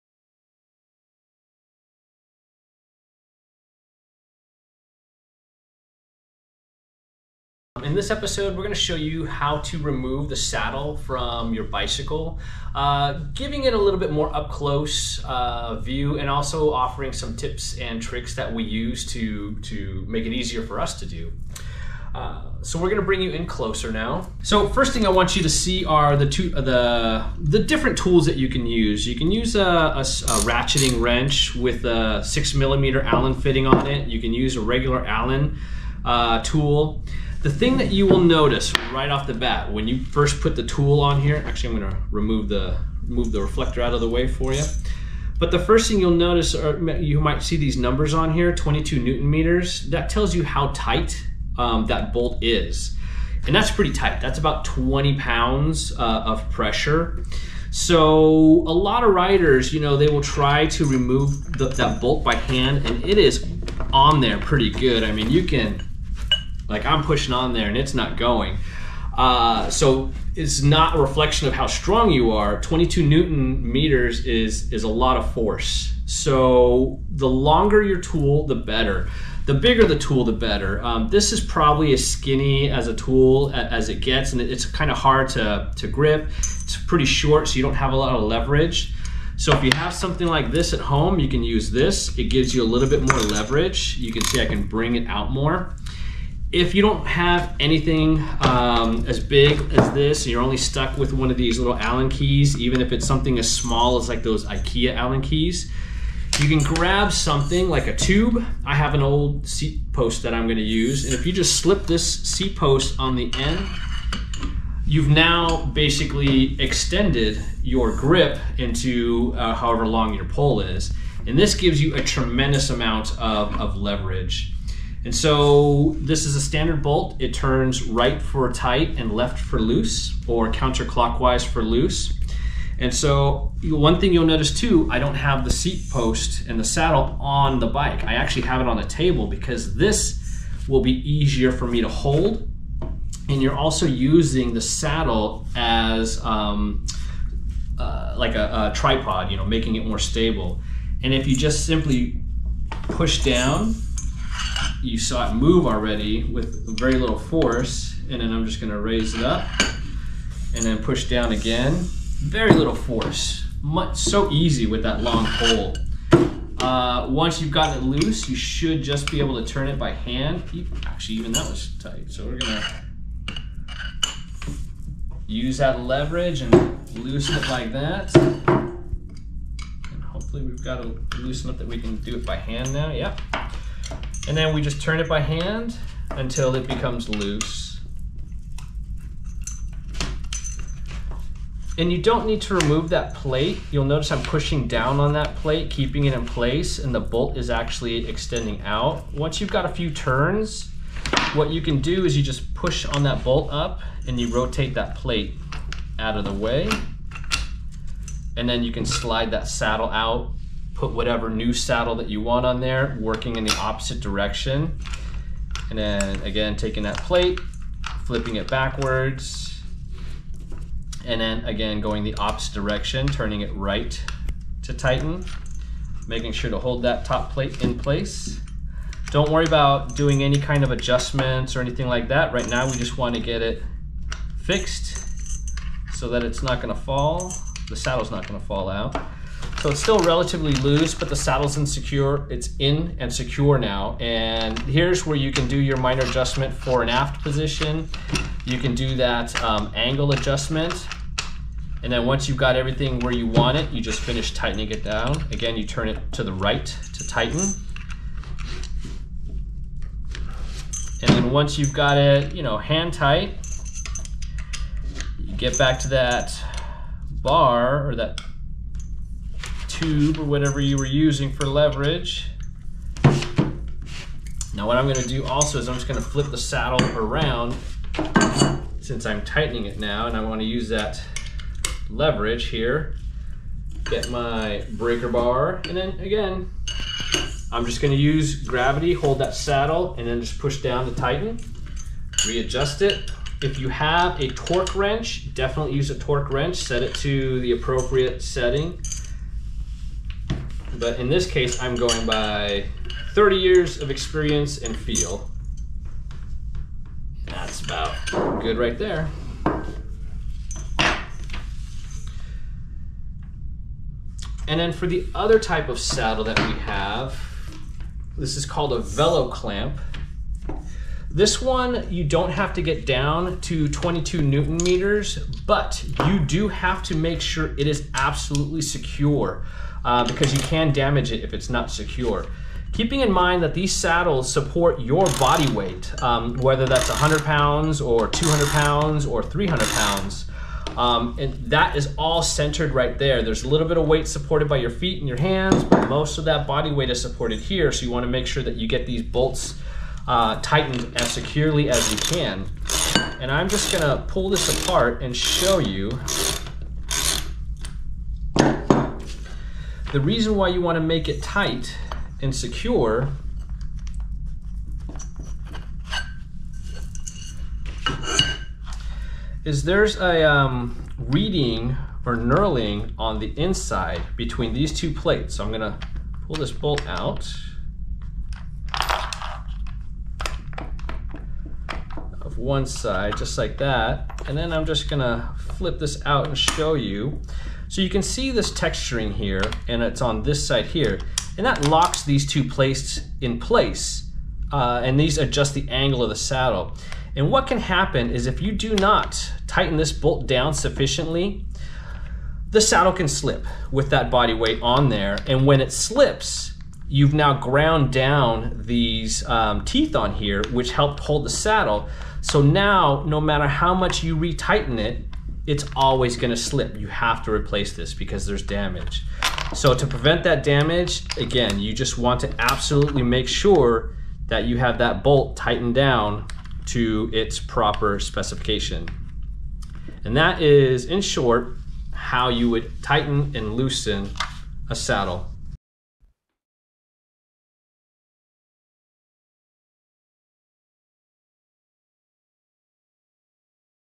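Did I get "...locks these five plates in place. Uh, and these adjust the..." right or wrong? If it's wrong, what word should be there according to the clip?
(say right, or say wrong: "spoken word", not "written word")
wrong: "two", not "five".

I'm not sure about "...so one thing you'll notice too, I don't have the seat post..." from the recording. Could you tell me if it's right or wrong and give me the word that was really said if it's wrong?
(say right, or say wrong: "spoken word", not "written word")
right.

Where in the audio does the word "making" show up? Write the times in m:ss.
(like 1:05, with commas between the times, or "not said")
2:29, 3:46.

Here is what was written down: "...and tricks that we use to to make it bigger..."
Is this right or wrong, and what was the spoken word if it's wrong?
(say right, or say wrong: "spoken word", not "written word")
wrong: "easier", not "bigger".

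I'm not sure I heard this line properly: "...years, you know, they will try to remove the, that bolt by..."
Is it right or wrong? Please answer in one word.
wrong.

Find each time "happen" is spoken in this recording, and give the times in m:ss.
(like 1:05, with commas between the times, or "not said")
6:37.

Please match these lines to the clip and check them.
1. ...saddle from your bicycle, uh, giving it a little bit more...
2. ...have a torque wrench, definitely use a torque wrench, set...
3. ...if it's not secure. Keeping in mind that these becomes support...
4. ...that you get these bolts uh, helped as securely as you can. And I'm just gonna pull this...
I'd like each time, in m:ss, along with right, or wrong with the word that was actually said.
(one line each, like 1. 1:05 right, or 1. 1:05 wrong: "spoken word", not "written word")
1. 0:10 right
2. 4:53 right
3. 5:31 wrong: "saddles", not "becomes"
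4. 5:48 wrong: "tightened", not "helped".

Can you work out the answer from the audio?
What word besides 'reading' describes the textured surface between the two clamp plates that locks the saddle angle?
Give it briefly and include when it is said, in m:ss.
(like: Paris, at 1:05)
knurling, at 6:12.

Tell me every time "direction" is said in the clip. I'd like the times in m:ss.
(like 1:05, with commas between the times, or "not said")
3:33, 3:42.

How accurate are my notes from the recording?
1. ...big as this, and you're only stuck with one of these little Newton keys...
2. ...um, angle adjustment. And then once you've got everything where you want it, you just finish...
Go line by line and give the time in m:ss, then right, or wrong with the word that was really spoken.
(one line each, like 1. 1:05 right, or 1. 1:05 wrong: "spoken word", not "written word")
1. 1:39 wrong: "Allen", not "Newton"
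2. 4:09 right.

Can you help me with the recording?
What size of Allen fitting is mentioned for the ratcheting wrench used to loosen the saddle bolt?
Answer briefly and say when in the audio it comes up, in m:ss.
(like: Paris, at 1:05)
6 millimeter, at 0:32.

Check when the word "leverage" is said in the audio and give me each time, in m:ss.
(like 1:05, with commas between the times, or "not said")
1:28, 1:33, 2:03, 2:55, 4:31, 4:41.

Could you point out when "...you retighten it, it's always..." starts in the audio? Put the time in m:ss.
6:54.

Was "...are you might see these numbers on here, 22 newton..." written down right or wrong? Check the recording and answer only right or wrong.
right.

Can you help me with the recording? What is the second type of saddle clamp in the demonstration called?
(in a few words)
velo clamp.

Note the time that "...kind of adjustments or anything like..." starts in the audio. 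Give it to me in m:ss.
3:50.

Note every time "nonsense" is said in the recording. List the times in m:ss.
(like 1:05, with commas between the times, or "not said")
not said.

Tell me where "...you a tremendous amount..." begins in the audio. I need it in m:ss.
2:01.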